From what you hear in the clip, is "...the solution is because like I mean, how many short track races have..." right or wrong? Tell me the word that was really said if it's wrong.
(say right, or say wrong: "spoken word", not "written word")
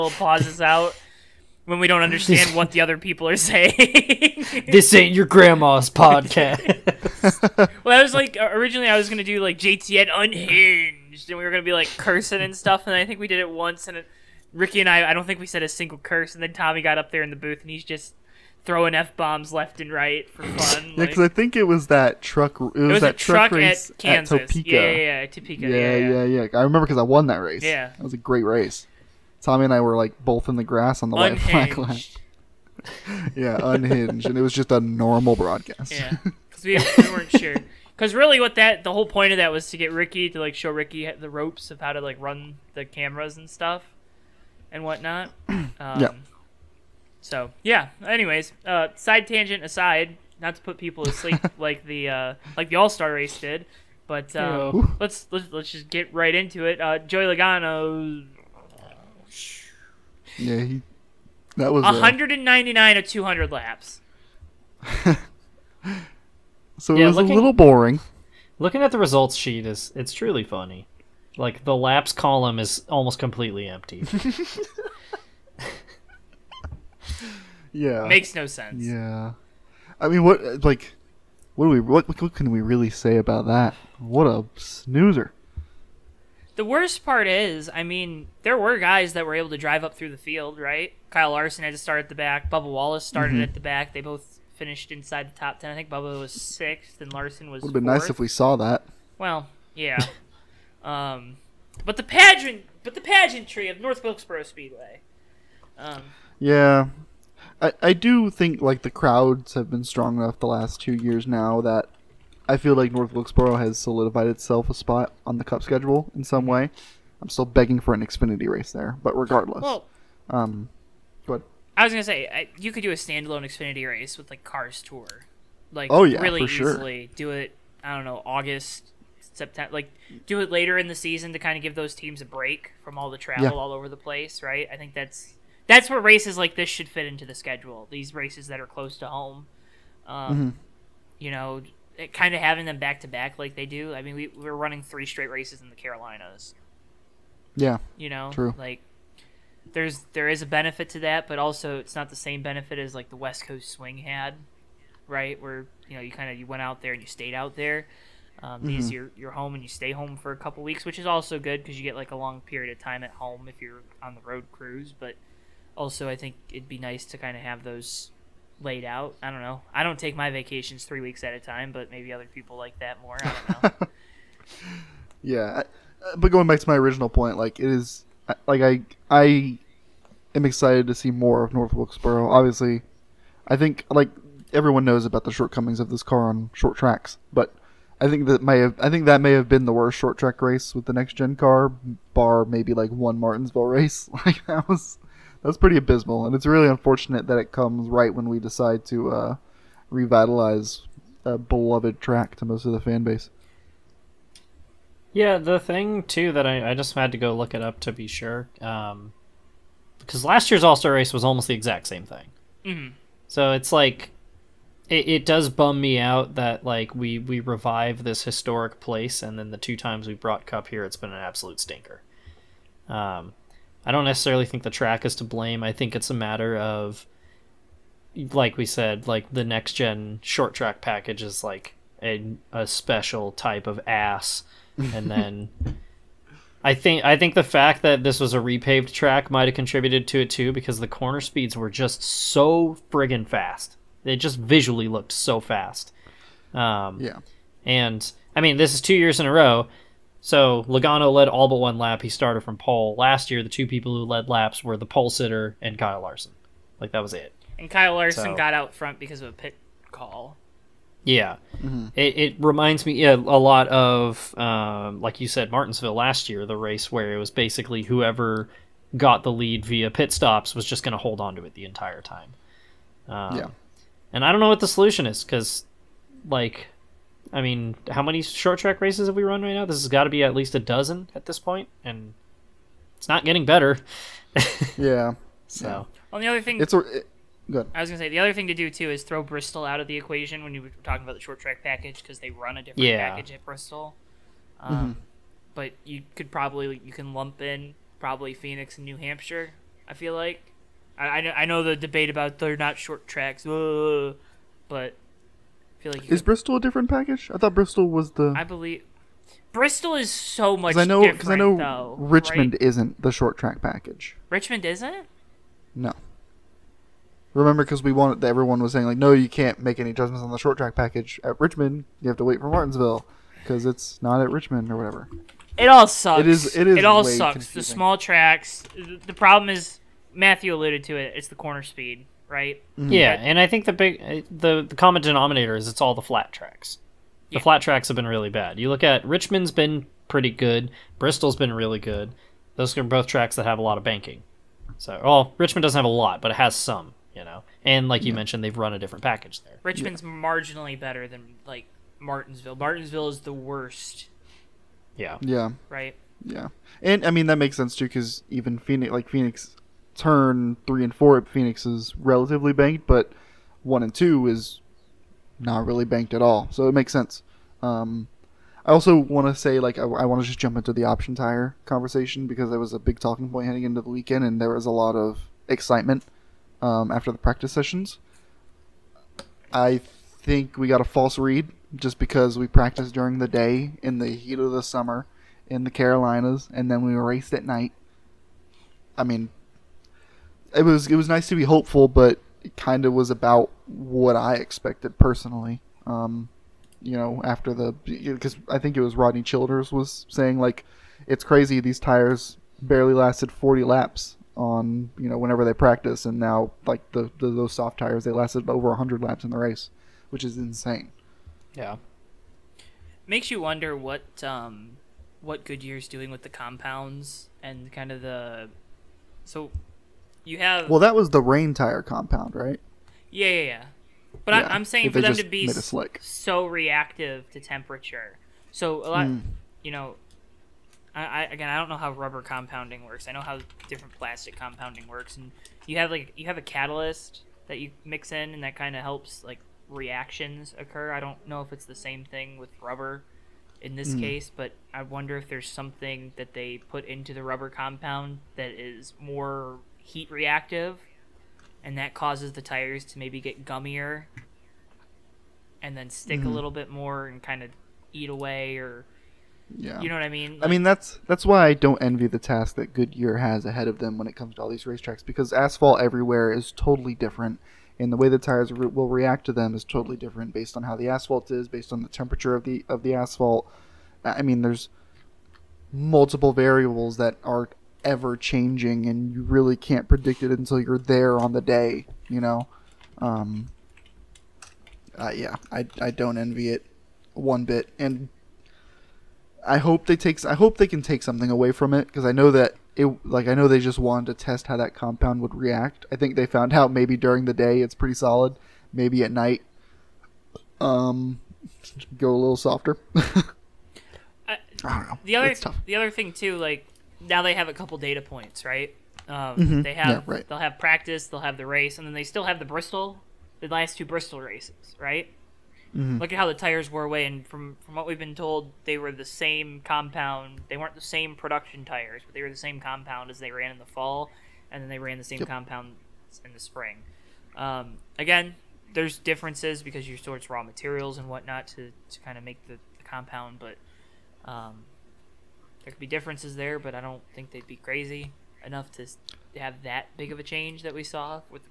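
right.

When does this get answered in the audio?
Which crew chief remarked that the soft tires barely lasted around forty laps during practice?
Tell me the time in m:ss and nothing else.
6:38.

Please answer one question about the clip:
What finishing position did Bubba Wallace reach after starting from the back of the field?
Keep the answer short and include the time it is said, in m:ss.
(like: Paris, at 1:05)
6th, at 1:36.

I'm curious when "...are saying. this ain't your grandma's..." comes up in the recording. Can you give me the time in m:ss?
0:03.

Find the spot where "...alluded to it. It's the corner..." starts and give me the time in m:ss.
5:30.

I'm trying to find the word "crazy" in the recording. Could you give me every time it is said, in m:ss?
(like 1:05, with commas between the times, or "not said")
6:41, 8:57.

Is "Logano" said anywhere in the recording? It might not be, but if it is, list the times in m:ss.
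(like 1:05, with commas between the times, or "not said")
0:57, 4:10.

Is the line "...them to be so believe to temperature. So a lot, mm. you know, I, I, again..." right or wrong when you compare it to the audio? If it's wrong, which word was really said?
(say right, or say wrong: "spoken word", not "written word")
wrong: "reactive", not "believe".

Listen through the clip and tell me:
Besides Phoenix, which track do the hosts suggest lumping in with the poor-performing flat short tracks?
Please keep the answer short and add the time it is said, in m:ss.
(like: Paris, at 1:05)
New Hampshire, at 4:58.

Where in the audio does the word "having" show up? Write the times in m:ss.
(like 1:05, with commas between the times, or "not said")
2:22.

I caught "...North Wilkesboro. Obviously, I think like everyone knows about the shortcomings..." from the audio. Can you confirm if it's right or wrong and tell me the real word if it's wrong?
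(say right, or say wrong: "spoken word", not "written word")
right.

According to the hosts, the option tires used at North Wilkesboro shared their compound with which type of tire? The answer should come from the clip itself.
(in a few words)
rain tire.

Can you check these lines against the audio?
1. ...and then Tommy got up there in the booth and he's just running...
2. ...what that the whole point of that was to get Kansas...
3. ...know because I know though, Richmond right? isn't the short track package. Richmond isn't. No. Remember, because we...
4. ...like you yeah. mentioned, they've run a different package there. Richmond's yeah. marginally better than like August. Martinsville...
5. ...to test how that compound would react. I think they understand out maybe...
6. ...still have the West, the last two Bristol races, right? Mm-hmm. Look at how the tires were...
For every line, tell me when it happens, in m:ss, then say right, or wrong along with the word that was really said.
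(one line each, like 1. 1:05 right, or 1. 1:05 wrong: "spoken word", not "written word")
1. 0:16 wrong: "throwing", not "running"
2. 0:38 wrong: "Ricky", not "Kansas"
3. 5:10 right
4. 5:47 wrong: "Martinsville", not "August"
5. 8:14 wrong: "found", not "understand"
6. 8:32 wrong: "Bristol", not "West".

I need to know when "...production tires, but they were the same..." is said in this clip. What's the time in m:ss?
8:41.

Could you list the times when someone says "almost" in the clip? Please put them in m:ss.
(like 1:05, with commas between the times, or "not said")
1:12, 3:31.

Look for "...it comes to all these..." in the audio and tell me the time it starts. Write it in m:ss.
7:44.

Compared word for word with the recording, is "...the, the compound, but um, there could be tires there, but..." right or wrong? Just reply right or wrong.
wrong.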